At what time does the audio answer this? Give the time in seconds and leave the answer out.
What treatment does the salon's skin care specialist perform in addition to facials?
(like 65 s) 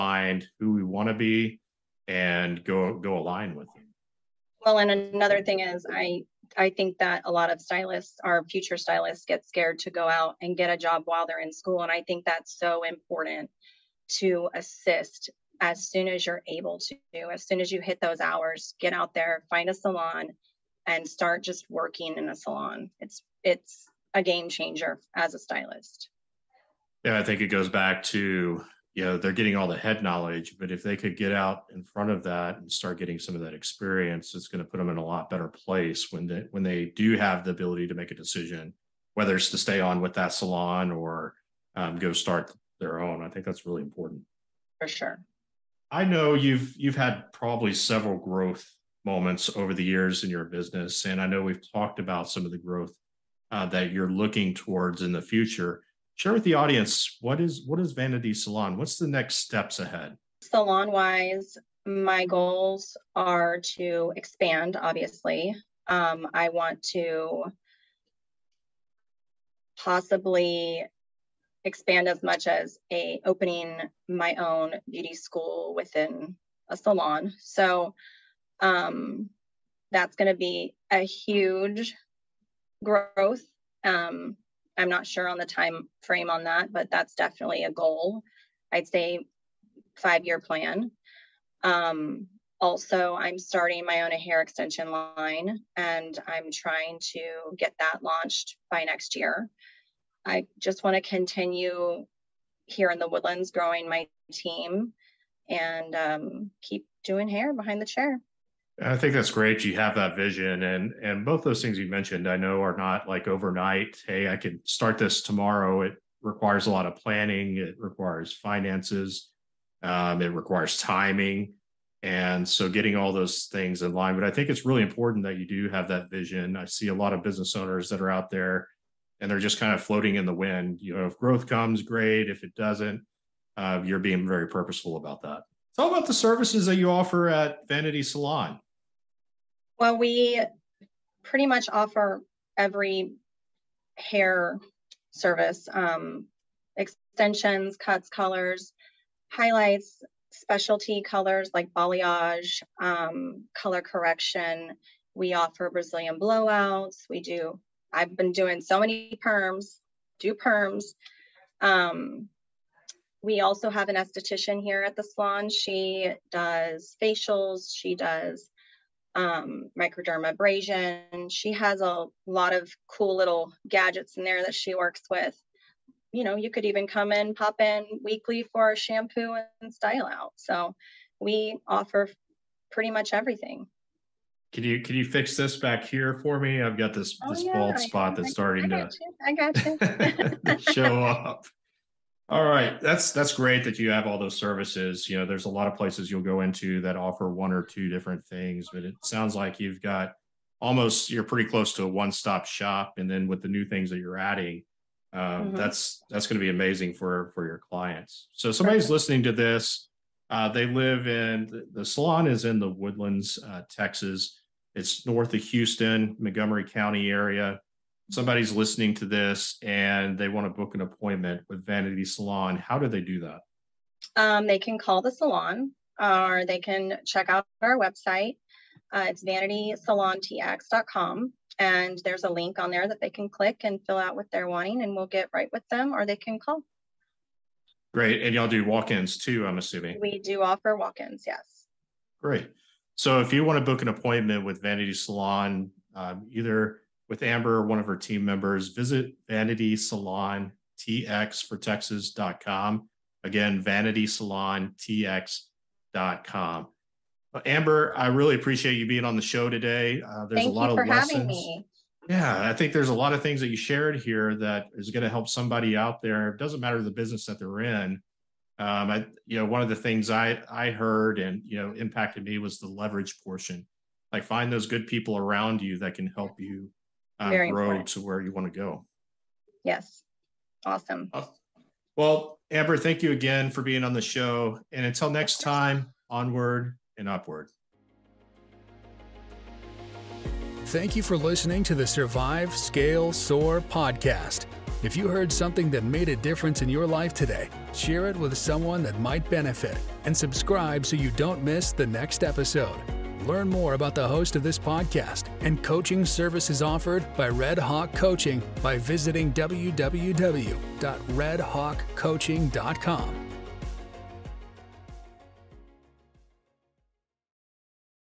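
169 s.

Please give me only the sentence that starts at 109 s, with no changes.
You have that vision, and and both those things you mentioned, I know, are not like overnight.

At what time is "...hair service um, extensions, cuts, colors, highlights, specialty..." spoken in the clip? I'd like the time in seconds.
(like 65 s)
143 s.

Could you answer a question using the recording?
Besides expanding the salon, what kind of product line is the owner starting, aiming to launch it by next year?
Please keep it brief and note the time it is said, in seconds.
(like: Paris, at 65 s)
Hair extension line, at 94 s.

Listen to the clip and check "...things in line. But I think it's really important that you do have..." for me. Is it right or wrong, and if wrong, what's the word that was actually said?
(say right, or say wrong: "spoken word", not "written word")
right.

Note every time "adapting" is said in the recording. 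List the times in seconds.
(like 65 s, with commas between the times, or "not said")
not said.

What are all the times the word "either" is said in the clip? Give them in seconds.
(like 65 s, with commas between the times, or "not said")
246 s.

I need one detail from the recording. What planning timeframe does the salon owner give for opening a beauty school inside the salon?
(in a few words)
5 year plan.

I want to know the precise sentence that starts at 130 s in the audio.
You know, if growth comes, great.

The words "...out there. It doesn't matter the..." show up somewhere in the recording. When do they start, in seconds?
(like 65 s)
265 s.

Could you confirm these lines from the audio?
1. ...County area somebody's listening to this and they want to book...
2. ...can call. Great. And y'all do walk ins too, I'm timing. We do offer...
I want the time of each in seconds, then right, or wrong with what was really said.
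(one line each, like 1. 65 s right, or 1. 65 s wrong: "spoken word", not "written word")
1. 216 s right
2. 236 s wrong: "assuming", not "timing".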